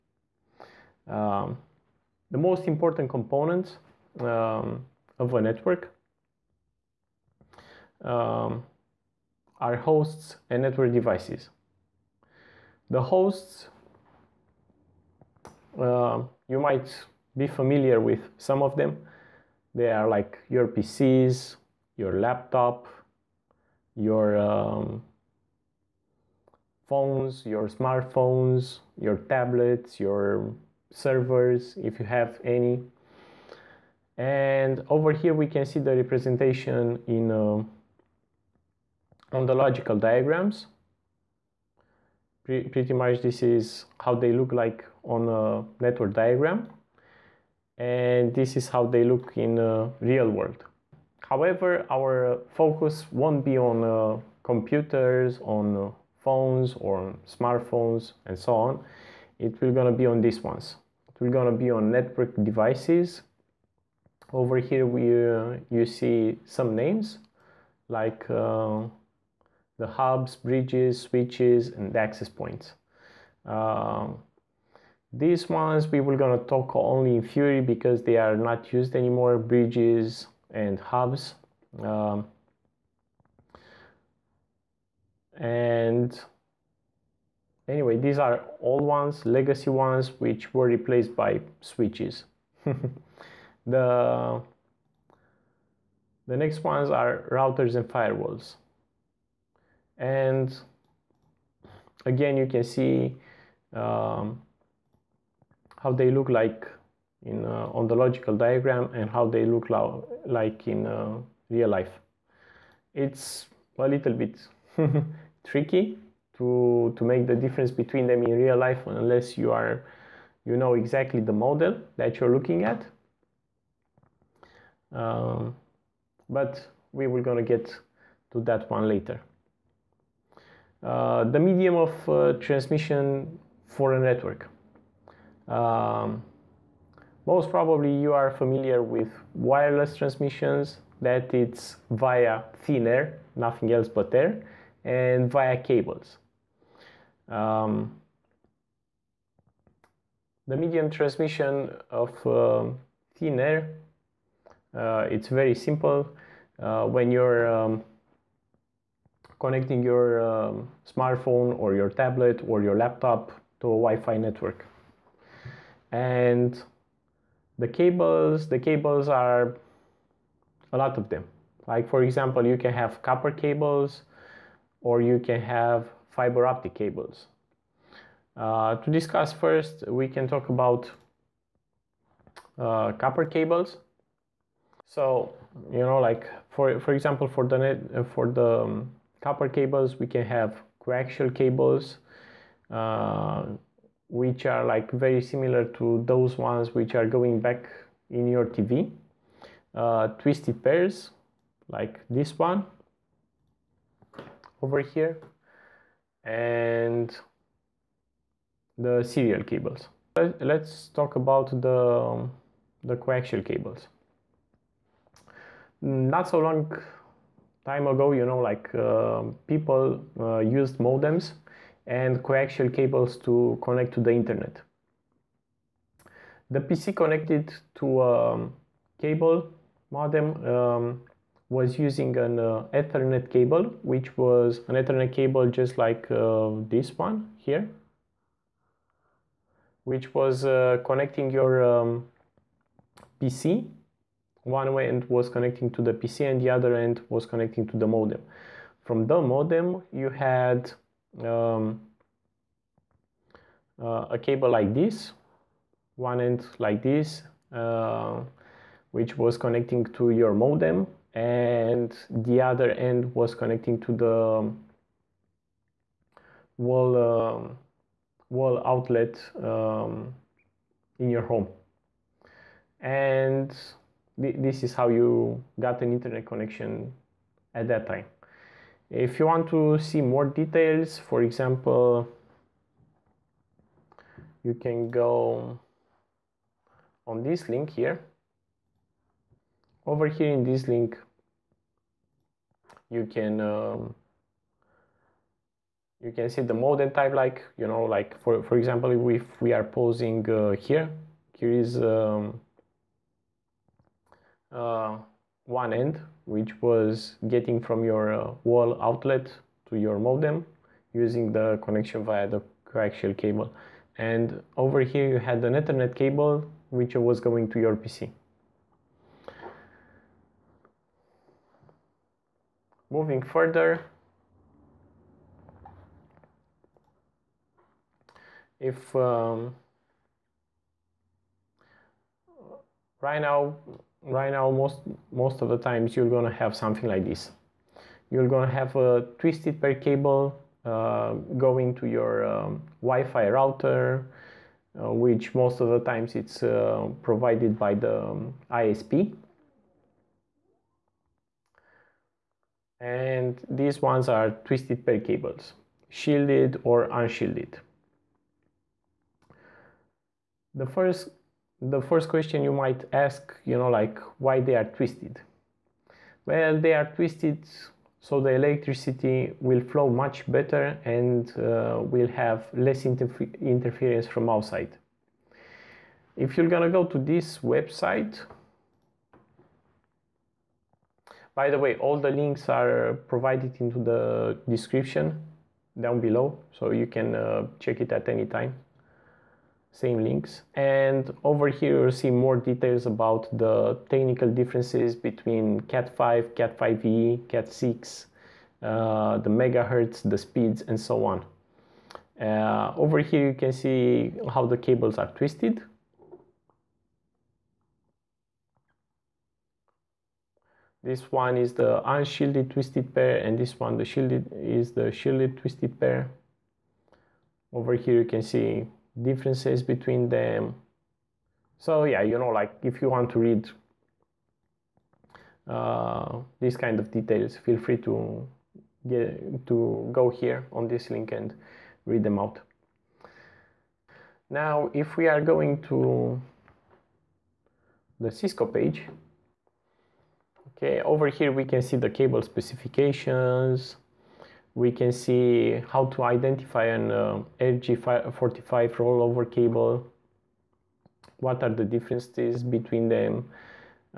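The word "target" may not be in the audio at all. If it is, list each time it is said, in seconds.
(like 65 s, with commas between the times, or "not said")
not said.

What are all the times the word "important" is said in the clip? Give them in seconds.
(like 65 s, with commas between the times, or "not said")
2 s.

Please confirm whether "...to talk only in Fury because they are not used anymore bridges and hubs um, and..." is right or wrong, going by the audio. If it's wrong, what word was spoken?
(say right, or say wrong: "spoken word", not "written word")
right.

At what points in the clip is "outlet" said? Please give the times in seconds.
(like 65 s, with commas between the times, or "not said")
268 s, 308 s.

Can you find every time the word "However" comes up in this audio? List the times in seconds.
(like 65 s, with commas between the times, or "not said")
51 s.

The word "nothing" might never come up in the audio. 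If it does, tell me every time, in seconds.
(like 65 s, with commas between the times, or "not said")
143 s.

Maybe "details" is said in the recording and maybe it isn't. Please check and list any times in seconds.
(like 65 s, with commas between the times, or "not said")
280 s, 392 s, 426 s.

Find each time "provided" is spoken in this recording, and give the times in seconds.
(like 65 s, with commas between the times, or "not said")
347 s, 383 s.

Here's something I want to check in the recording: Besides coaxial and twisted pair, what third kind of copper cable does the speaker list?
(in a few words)
serial cables.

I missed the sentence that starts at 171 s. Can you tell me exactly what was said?
Like for example, you can have copper cables or you can have fiber optic cables.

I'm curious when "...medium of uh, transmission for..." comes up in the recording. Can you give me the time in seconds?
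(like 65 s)
131 s.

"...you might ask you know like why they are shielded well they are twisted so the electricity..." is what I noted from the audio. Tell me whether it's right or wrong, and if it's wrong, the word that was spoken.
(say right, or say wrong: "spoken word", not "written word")
wrong: "twisted", not "shielded".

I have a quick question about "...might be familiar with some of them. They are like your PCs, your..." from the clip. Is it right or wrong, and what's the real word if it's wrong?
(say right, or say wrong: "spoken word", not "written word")
right.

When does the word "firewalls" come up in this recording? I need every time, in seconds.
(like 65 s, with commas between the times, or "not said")
97 s.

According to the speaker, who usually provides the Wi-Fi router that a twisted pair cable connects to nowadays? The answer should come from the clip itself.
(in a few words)
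ISP.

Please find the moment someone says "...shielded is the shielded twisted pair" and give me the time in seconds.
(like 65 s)
413 s.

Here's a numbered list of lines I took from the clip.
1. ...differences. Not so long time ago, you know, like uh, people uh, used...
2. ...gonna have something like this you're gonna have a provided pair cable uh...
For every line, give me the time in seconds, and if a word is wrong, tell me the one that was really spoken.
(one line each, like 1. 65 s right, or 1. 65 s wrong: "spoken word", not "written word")
1. 213 s wrong: "cables", not "differences"
2. 336 s wrong: "twisted", not "provided".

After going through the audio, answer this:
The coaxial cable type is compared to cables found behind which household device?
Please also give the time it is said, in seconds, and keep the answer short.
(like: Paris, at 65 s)
TV, at 198 s.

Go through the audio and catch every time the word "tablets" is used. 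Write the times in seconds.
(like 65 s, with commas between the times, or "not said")
29 s, 161 s.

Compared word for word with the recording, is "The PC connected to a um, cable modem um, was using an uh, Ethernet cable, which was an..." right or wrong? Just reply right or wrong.
right.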